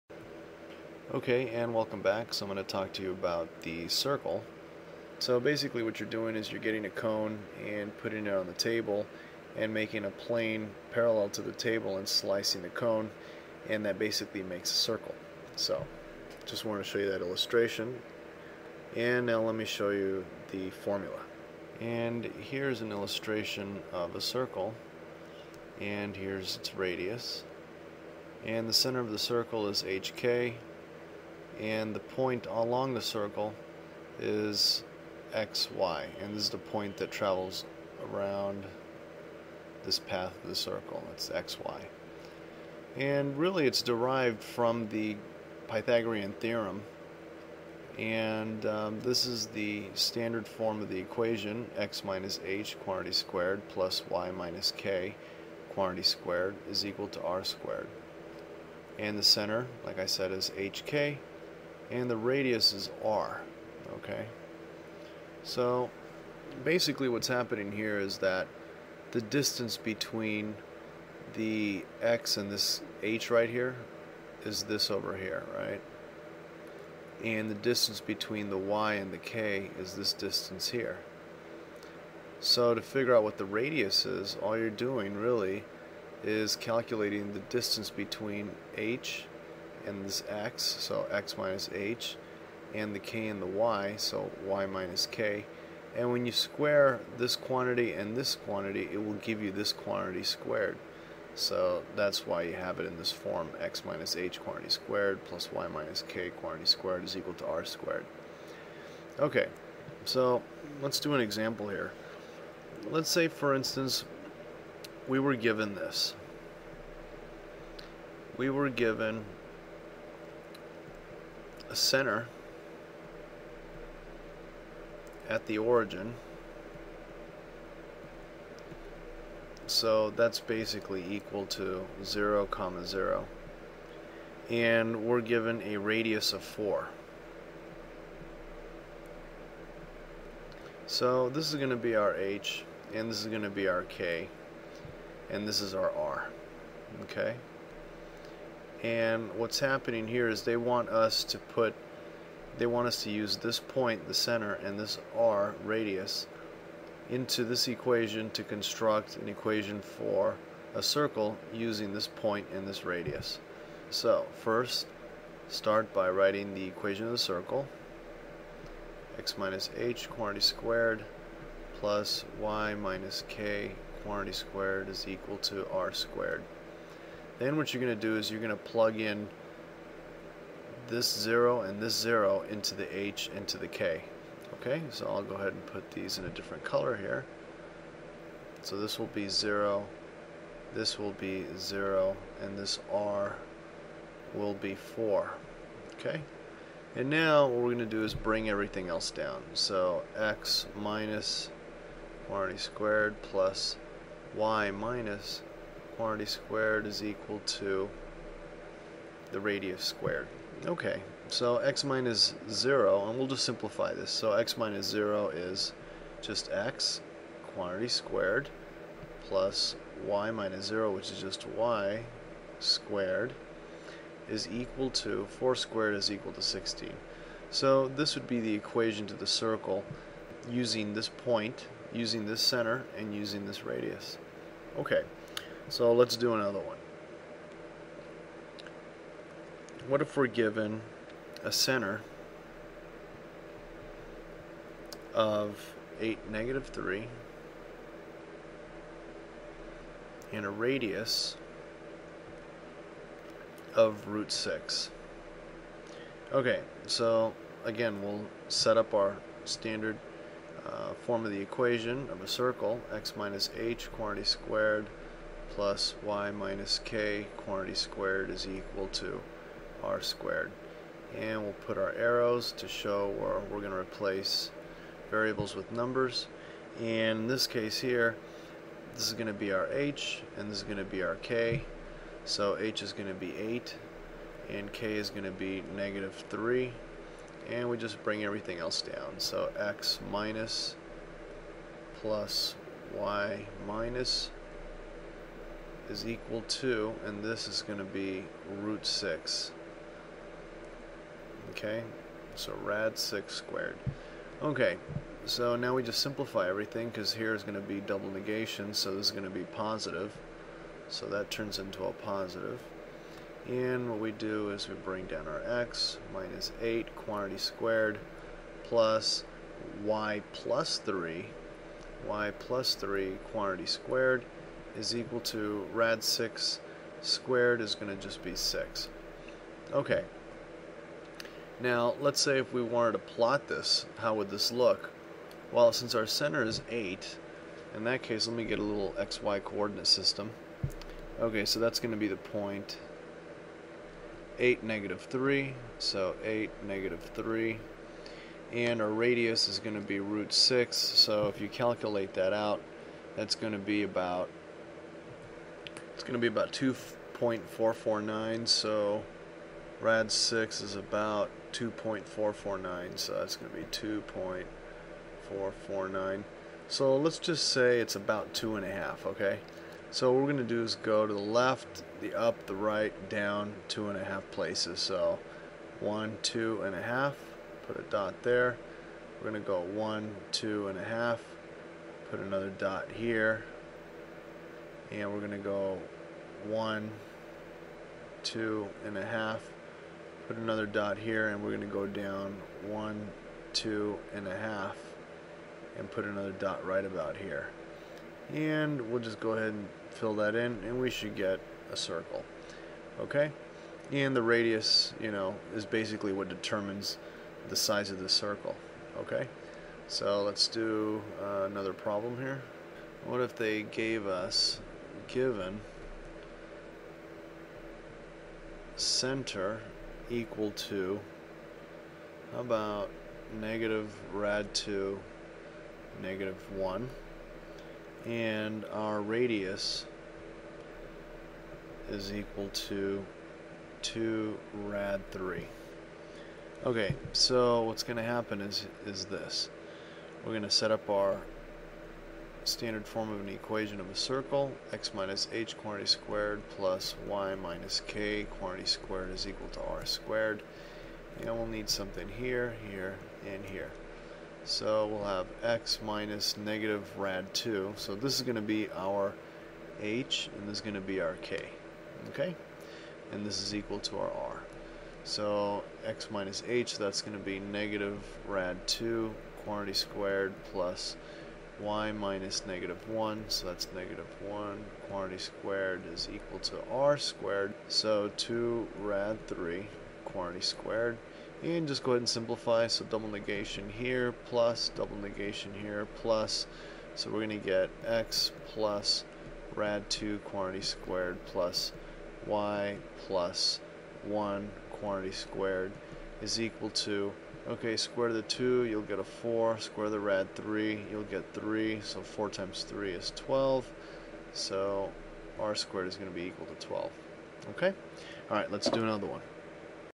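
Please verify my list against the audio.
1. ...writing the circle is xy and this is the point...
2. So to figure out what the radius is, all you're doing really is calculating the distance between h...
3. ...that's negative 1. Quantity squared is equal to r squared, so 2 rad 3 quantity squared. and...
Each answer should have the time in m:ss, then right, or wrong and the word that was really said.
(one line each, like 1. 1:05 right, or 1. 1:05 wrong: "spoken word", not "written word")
1. 0:32 wrong: "along", not "writing"
2. 1:22 right
3. 7:53 right.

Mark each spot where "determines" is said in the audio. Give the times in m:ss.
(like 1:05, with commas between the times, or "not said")
6:46.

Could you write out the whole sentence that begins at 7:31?
And we'll need something here, here, and here.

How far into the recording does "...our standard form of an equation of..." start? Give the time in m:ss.
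7:20.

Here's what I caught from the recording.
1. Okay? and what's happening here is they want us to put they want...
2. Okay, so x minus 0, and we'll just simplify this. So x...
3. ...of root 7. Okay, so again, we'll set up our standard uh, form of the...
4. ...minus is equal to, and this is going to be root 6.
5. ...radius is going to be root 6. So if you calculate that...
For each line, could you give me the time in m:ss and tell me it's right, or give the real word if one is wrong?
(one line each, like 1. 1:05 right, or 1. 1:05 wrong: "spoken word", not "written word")
1. 2:27 right
2. 3:30 right
3. 4:13 wrong: "6", not "7"
4. 4:53 right
5. 5:48 right.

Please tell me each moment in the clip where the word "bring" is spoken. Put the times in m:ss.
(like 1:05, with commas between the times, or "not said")
3:18, 4:48, 5:14.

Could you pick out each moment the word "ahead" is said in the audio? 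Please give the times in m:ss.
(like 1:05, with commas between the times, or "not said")
3:05, 6:39, 8:01.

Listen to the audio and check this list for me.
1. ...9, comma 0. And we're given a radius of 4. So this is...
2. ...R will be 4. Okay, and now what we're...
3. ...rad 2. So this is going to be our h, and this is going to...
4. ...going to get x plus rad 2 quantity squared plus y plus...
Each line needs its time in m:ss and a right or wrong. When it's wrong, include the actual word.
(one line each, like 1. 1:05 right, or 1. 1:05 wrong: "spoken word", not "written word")
1. 2:12 wrong: "0", not "9"
2. 3:12 right
3. 7:36 right
4. 8:07 right.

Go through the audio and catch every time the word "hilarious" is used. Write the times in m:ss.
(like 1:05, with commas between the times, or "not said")
not said.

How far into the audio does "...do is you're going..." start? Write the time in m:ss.
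2:57.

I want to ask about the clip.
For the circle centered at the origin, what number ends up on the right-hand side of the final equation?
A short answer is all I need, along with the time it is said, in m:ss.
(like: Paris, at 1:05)
16, at 3:46.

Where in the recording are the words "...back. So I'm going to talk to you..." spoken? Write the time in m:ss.
0:02.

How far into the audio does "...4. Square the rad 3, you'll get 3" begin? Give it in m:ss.
8:19.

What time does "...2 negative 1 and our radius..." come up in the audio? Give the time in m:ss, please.
7:04.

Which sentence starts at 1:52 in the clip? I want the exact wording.
Let's say, for instance, we were given this.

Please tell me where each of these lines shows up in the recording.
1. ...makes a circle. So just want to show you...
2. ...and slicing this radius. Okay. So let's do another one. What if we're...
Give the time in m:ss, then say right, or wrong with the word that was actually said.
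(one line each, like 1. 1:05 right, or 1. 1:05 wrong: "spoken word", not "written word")
1. 0:14 right
2. 3:52 wrong: "using", not "slicing".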